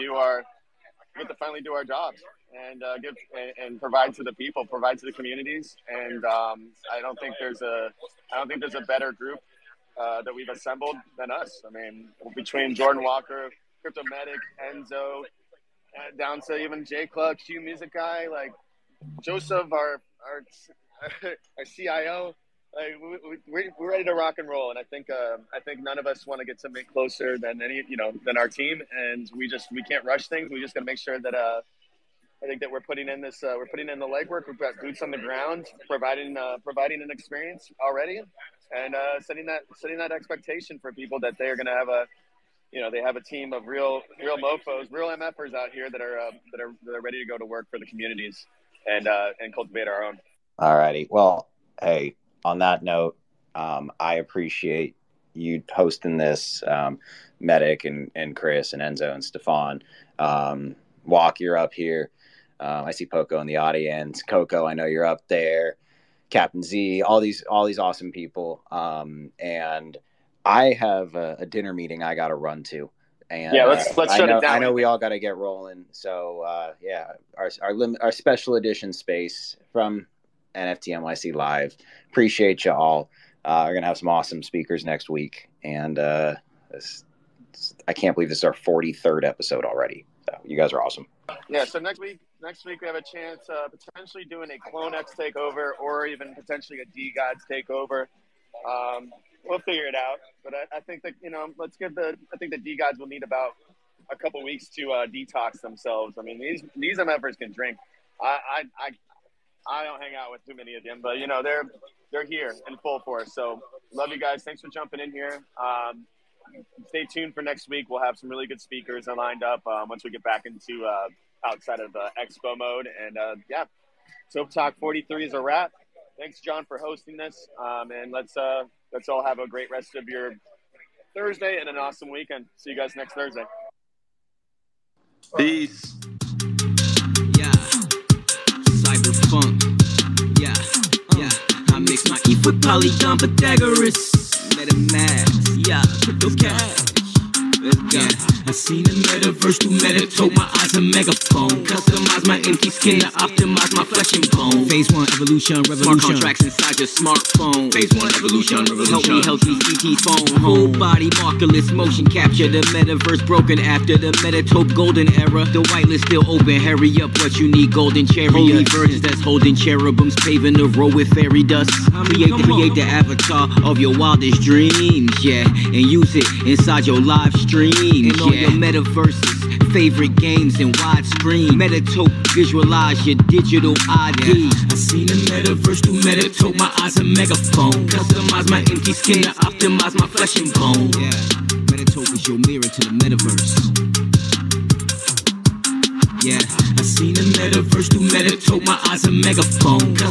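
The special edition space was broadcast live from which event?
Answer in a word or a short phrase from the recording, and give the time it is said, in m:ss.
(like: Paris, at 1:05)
NFTNYC, at 1:20.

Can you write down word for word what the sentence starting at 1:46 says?
I mean, these these MFers can drink.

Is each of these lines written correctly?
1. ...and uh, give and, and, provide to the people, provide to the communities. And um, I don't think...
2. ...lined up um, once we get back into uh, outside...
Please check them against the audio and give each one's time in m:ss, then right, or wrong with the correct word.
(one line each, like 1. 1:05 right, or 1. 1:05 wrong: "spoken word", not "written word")
1. 0:02 right
2. 1:59 right.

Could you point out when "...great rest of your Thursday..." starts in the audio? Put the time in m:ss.
2:09.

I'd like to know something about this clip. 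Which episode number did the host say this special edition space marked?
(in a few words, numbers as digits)
43rd.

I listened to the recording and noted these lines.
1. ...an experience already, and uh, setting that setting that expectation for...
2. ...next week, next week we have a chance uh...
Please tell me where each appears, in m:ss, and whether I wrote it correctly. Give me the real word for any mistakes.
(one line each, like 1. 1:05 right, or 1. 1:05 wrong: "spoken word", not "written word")
1. 0:37 right
2. 1:31 right.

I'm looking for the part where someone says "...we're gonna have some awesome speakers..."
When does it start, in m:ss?
1:23.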